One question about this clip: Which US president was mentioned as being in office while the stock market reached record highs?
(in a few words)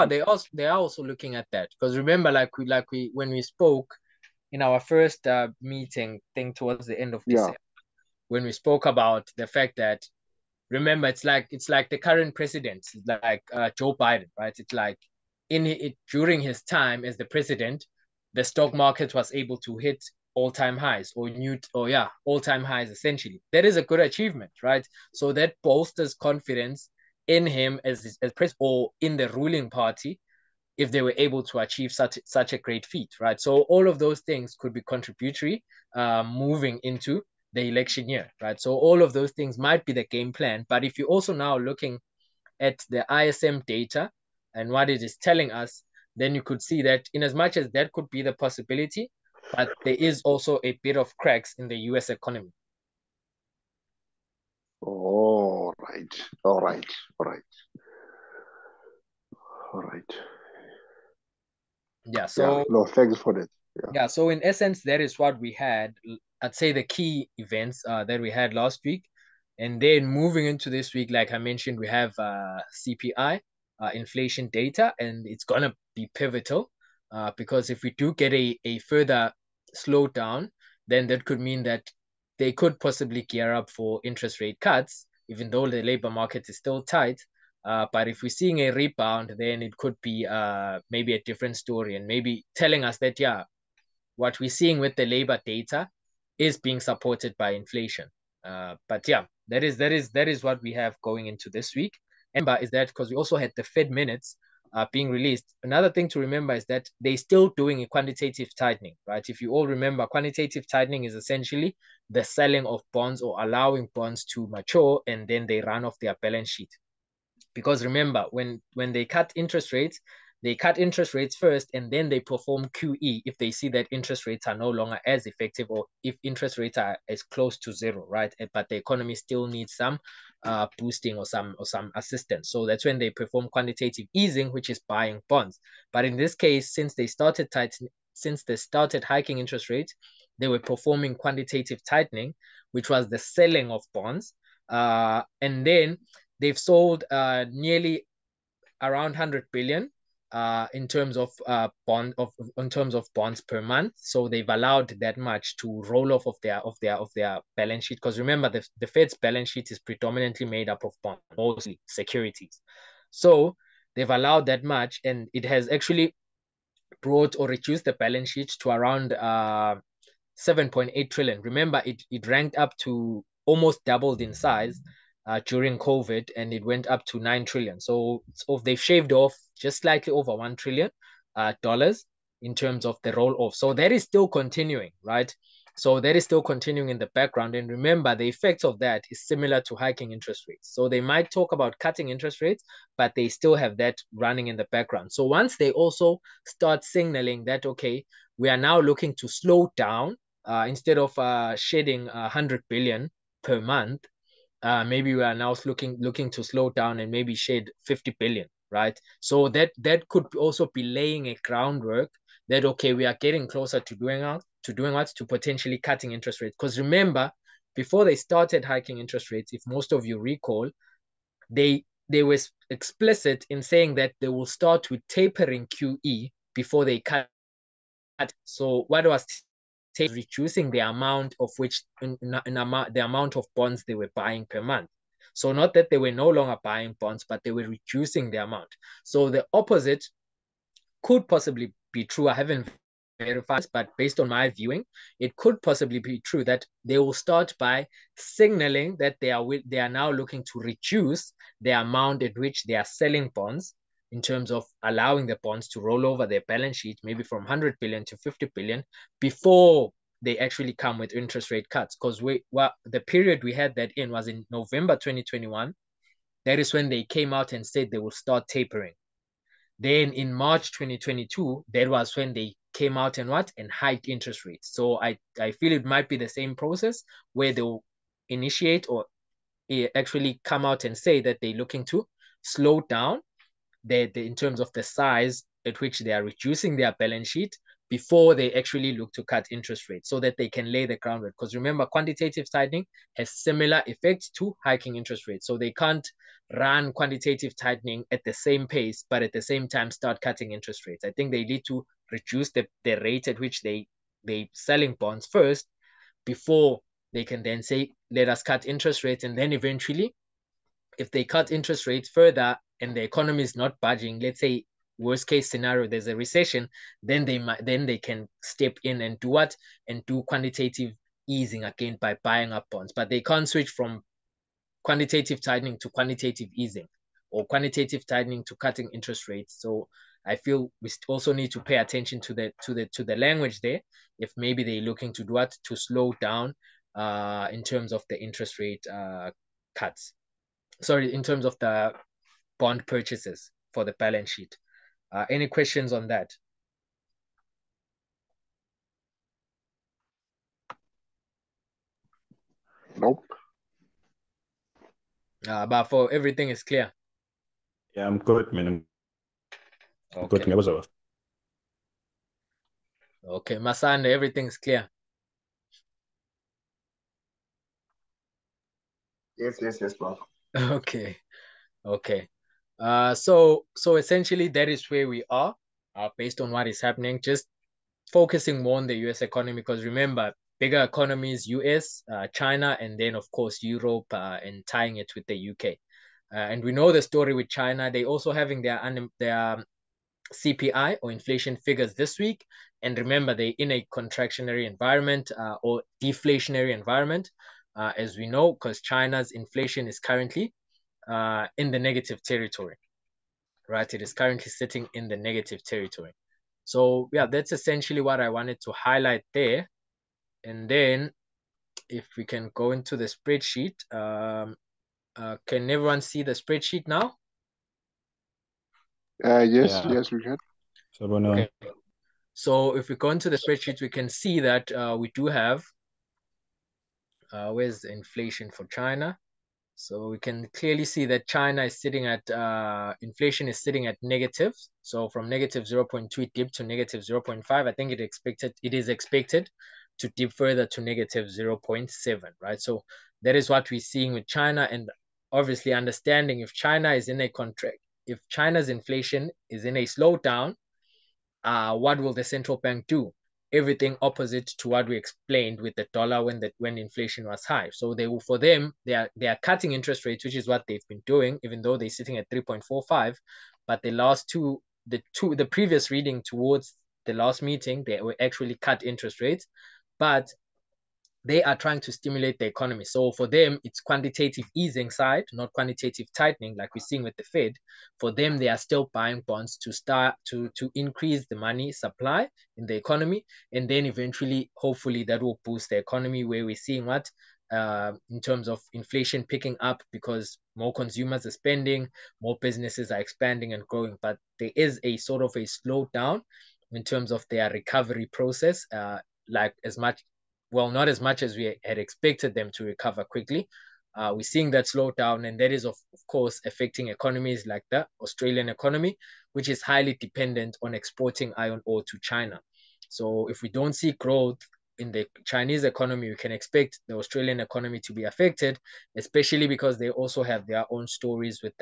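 Joe Biden.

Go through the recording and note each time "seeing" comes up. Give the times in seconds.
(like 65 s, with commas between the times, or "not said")
88 s, 94 s, 443 s, 476 s, 486 s, 504 s.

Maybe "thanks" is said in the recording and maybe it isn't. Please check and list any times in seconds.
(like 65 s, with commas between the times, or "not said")
62 s.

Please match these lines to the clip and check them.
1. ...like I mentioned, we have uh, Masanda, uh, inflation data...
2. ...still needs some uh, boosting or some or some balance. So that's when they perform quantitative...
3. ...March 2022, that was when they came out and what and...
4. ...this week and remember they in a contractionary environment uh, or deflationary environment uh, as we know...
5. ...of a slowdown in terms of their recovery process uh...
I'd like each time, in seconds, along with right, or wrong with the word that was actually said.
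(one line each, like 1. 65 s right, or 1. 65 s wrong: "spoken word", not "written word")
1. 71 s wrong: "CPI", not "Masanda"
2. 129 s wrong: "assistance", not "balance"
3. 270 s right
4. 391 s right
5. 495 s right.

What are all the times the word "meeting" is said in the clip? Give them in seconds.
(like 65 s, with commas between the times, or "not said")
5 s, 467 s.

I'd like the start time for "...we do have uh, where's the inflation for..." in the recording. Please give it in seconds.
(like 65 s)
424 s.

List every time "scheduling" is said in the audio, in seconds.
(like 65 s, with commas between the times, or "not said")
not said.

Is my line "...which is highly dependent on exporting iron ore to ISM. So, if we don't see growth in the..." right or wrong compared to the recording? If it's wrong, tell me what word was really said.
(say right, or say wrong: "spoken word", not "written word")
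wrong: "China", not "ISM".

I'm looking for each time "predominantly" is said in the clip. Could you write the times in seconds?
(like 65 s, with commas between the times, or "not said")
159 s.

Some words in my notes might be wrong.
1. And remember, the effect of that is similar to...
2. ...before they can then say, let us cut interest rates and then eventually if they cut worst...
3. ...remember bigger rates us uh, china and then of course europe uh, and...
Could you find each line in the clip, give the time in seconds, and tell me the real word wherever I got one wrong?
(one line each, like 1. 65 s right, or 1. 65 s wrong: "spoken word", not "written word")
1. 187 s right
2. 306 s wrong: "interest", not "worst"
3. 379 s wrong: "economies", not "rates".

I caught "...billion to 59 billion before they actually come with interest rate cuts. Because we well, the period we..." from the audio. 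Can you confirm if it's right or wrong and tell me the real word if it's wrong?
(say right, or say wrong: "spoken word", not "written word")
wrong: "50", not "59".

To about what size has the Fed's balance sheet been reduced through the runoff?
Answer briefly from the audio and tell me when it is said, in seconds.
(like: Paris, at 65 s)
7.8 trillion, at 170 s.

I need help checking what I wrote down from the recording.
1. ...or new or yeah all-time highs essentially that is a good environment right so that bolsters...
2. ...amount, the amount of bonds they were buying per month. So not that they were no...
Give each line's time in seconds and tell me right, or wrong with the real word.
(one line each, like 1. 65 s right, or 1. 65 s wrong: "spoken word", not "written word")
1. 21 s wrong: "achievement", not "environment"
2. 232 s right.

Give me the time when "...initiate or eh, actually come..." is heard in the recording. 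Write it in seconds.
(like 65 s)
278 s.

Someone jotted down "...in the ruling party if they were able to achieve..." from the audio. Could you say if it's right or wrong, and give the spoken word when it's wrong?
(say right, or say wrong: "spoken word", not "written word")
right.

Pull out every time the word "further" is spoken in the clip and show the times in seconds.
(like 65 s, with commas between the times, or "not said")
78 s, 312 s, 440 s.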